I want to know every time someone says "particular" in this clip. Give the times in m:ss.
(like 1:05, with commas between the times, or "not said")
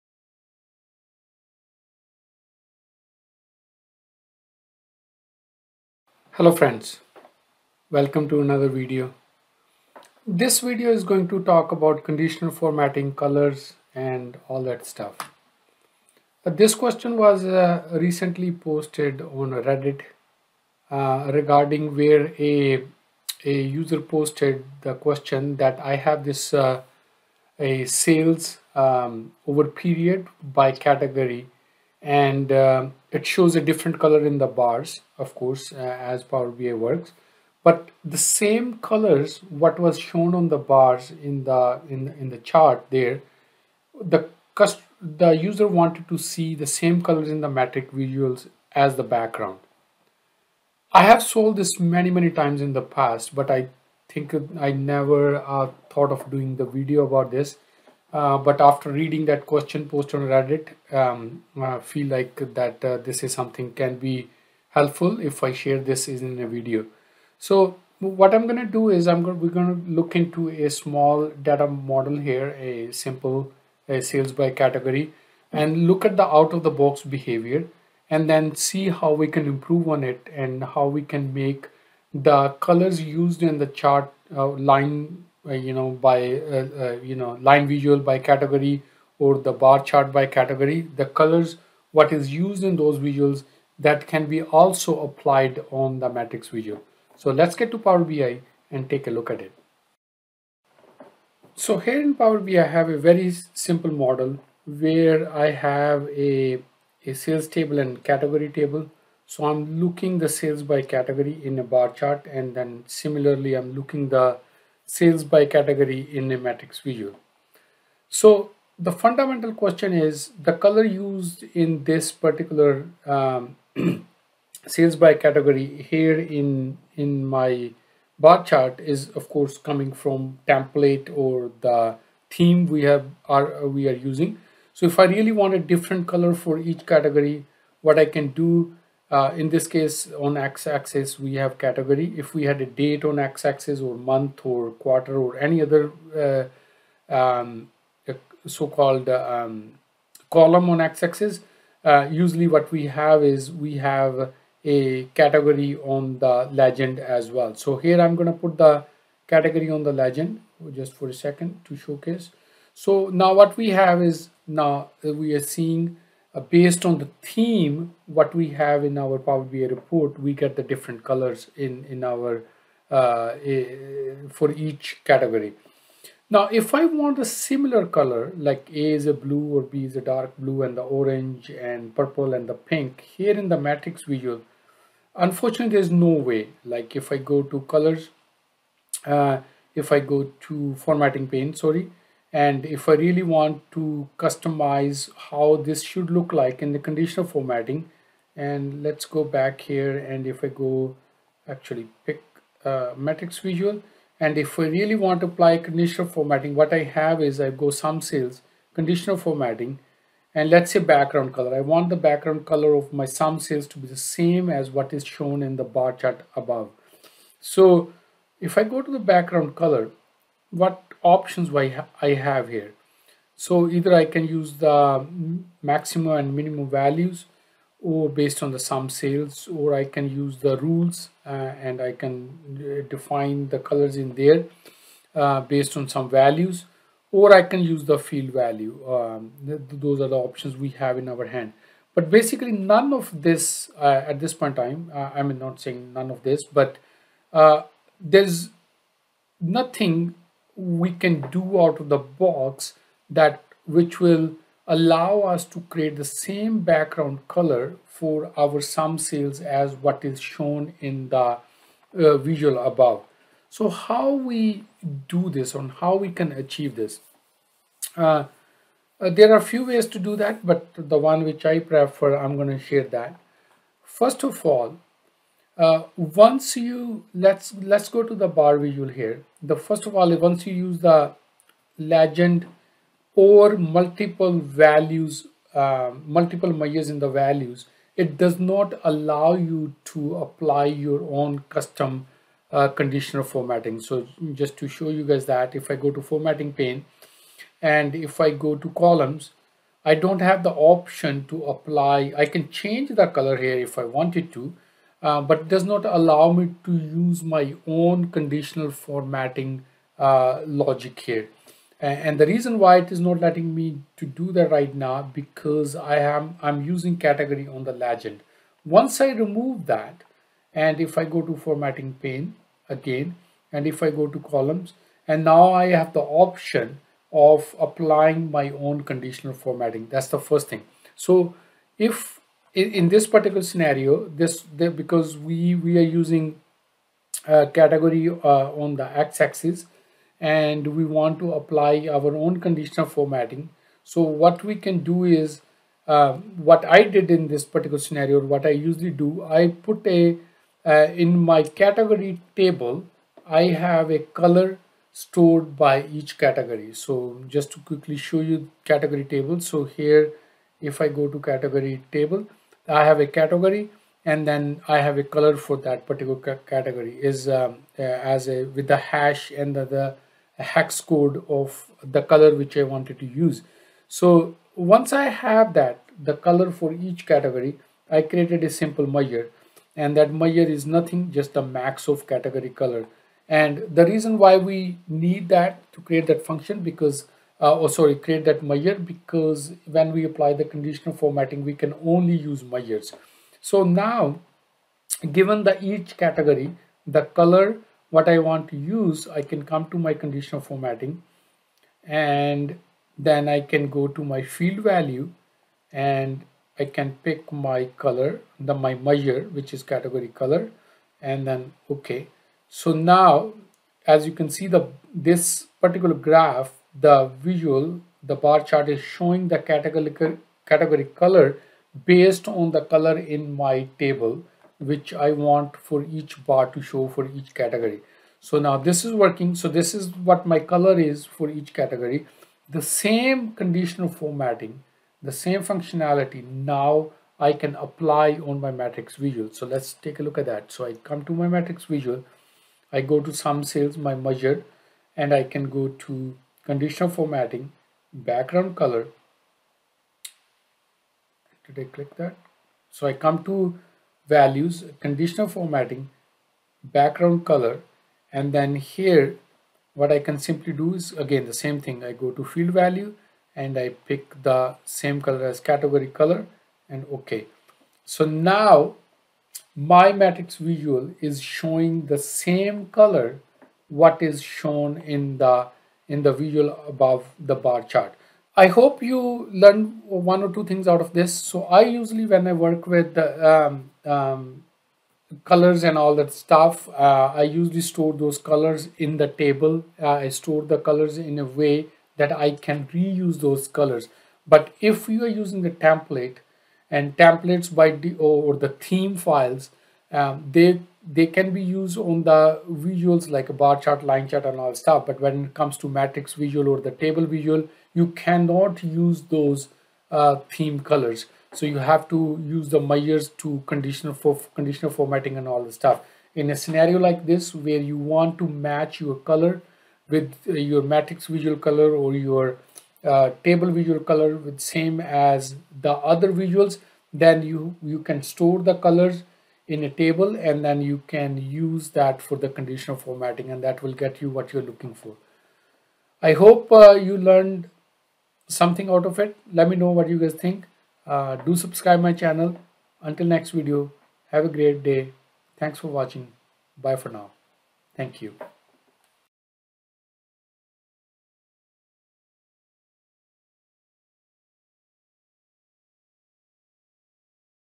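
2:02, 5:33, 5:47, 6:05, 6:55.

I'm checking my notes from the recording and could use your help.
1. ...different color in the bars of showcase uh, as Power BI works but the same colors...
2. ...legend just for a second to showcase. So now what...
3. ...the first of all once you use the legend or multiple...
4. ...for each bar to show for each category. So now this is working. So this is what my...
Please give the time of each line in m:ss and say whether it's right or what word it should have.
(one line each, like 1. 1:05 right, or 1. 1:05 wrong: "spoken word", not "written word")
1. 0:33 wrong: "course", not "showcase"
2. 2:39 right
3. 4:39 right
4. 7:05 right.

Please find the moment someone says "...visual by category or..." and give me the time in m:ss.
1:27.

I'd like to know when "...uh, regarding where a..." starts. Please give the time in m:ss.
0:20.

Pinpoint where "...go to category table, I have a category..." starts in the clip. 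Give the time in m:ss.
6:00.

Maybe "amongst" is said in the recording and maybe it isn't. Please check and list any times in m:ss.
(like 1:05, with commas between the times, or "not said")
not said.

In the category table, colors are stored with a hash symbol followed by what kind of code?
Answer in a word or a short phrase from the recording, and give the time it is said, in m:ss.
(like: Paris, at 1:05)
hex code, at 6:10.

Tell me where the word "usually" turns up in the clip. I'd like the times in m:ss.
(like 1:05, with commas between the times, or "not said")
2:32, 5:48, 8:01, 8:07.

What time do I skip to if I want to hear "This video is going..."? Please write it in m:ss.
0:10.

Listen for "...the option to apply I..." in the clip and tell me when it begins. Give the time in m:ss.
5:00.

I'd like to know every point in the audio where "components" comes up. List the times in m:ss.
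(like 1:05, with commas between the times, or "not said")
not said.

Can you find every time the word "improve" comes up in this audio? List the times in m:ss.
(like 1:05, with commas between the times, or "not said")
1:19.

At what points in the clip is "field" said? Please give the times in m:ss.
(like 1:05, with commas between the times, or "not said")
3:57, 6:44, 7:42.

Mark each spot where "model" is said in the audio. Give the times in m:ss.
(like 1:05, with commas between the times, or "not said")
1:11, 1:43.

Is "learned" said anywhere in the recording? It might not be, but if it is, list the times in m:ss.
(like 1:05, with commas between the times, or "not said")
7:59, 8:56.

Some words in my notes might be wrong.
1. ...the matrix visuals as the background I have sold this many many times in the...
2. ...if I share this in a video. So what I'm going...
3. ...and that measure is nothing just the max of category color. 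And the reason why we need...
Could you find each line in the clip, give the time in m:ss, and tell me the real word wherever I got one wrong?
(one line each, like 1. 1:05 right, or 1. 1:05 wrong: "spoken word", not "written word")
1. 0:47 right
2. 1:05 right
3. 6:19 right.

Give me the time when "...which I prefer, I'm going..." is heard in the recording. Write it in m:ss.
4:31.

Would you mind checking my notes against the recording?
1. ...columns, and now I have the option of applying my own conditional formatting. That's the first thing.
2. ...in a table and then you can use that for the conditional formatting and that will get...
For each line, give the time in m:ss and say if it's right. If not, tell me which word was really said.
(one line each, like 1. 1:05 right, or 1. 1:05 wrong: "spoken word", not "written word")
1. 5:24 right
2. 8:49 right.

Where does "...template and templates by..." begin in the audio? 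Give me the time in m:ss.
8:15.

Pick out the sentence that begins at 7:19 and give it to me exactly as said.
So let's take a look at that.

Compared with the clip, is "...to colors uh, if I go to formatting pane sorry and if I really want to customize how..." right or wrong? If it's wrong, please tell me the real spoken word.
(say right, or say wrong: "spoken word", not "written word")
right.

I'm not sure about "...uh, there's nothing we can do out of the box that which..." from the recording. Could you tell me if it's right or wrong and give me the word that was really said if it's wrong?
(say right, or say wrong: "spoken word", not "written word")
right.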